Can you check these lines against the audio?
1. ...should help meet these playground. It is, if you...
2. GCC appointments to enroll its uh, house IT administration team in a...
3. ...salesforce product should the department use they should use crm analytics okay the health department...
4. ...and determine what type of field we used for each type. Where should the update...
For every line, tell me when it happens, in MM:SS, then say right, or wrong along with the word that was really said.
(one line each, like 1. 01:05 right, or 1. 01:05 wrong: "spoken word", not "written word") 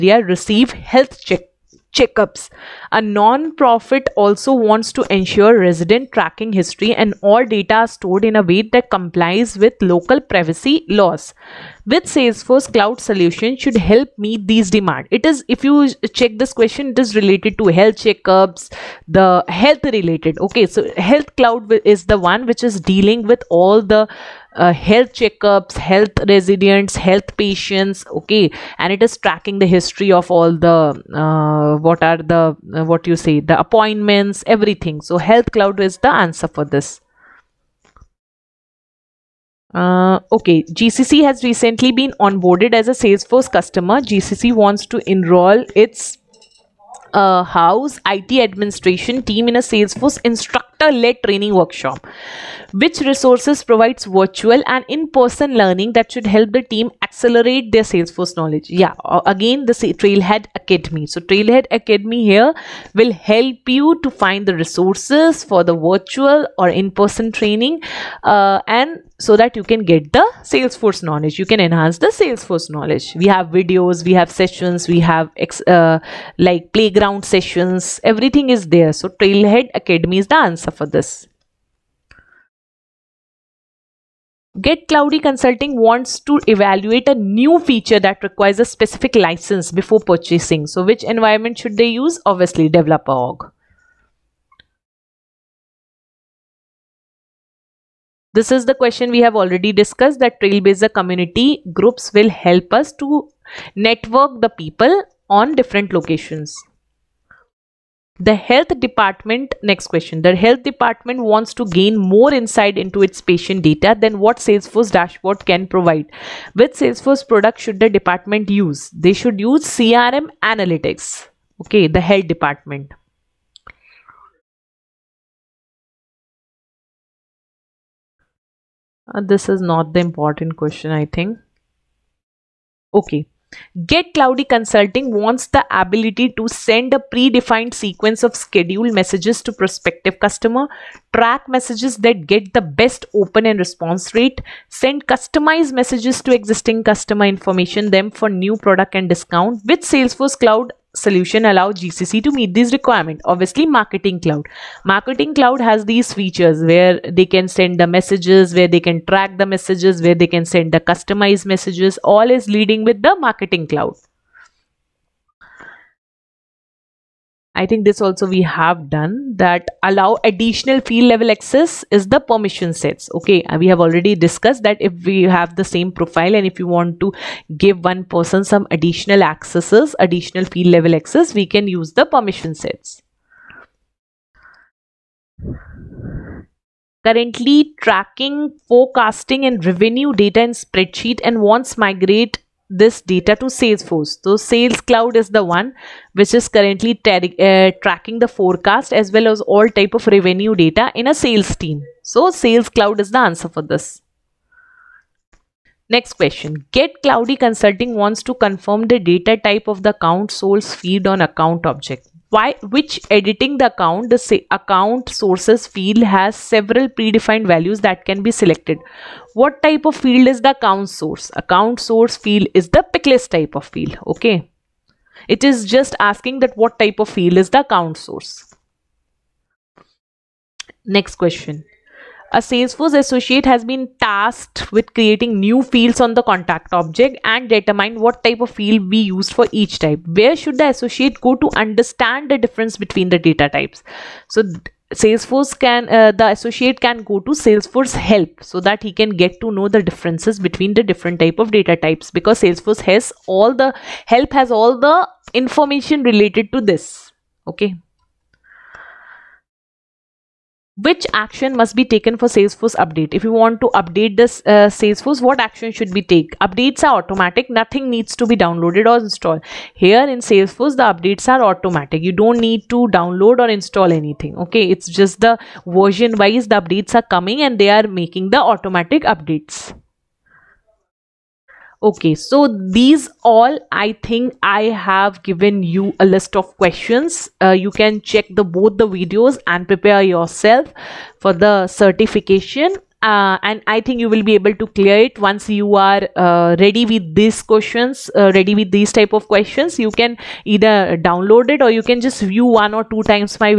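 1. 00:13 wrong: "demand", not "playground"
2. 00:44 wrong: "wants", not "appointments"
3. 01:56 right
4. 03:57 wrong: "associate", not "update".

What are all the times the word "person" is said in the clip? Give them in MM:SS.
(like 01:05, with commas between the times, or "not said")
00:55, 01:06, 02:58.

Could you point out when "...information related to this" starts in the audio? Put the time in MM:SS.
04:15.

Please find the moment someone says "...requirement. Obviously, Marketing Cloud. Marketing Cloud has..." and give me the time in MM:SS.
02:32.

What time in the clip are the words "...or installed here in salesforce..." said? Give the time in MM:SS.
04:28.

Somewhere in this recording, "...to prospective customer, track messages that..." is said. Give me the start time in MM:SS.
02:19.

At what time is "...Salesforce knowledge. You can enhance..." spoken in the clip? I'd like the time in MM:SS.
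01:10.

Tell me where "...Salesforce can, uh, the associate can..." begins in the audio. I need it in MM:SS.
04:04.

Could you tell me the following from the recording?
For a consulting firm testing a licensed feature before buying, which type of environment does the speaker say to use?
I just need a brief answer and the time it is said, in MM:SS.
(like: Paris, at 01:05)
Developer org, at 01:32.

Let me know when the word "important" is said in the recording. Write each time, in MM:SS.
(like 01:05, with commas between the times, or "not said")
02:10.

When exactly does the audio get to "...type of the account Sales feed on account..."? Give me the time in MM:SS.
03:29.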